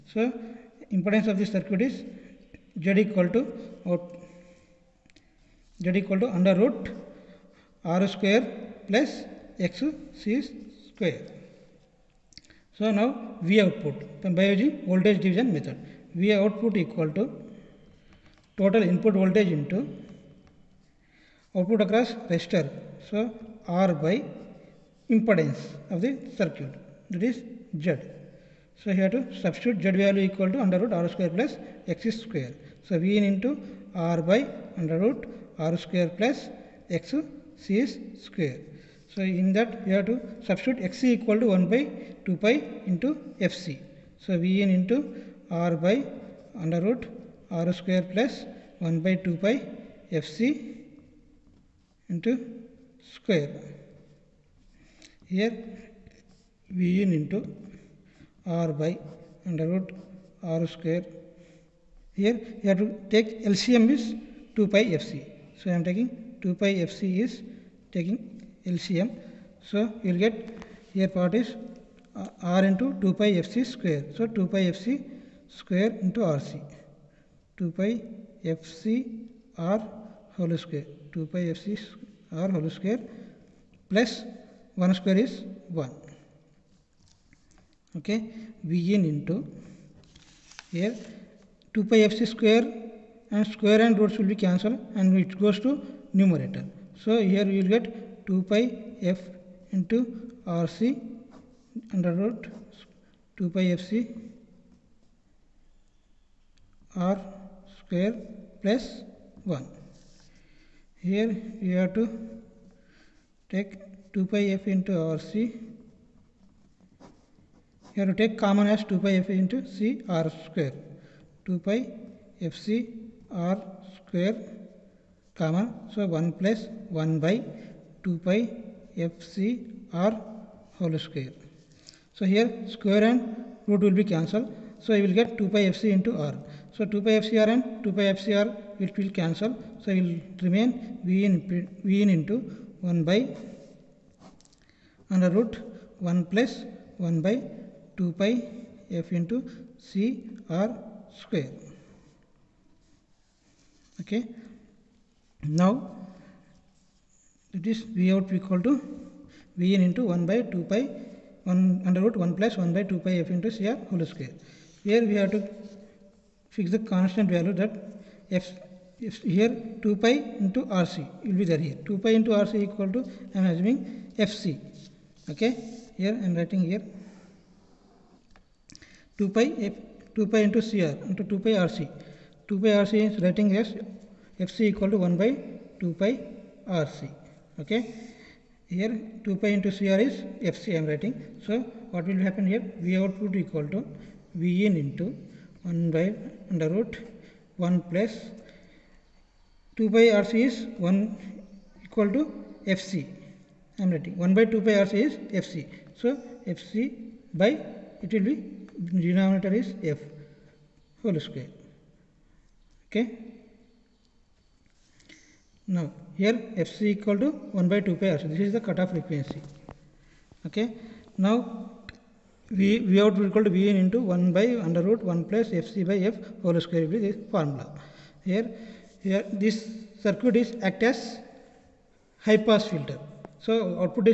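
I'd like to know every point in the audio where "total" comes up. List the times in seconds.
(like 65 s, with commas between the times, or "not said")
18 s.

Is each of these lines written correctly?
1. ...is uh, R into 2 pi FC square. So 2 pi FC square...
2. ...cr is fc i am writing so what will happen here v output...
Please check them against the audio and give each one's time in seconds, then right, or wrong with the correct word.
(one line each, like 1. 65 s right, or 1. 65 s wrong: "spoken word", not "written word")
1. 71 s right
2. 189 s right.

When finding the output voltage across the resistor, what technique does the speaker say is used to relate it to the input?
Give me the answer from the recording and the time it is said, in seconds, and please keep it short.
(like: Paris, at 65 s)
Voltage division method, at 14 s.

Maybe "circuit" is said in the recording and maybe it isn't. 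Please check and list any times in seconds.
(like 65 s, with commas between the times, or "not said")
1 s, 26 s, 230 s.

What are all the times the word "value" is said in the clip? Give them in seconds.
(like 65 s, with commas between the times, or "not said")
29 s, 167 s.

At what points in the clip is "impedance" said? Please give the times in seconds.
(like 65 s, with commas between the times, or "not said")
0 s, 25 s.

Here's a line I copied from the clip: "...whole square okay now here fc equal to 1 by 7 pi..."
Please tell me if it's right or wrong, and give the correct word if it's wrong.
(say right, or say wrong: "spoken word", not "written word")
wrong: "2", not "7".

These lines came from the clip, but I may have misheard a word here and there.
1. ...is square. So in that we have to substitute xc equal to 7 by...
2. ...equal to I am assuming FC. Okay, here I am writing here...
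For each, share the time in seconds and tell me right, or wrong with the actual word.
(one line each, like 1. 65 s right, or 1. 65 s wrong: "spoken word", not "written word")
1. 37 s wrong: "1", not "7"
2. 172 s right.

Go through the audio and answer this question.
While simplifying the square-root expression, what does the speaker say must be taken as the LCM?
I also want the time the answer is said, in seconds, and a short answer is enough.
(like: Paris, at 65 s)
2 pi fc, at 63 s.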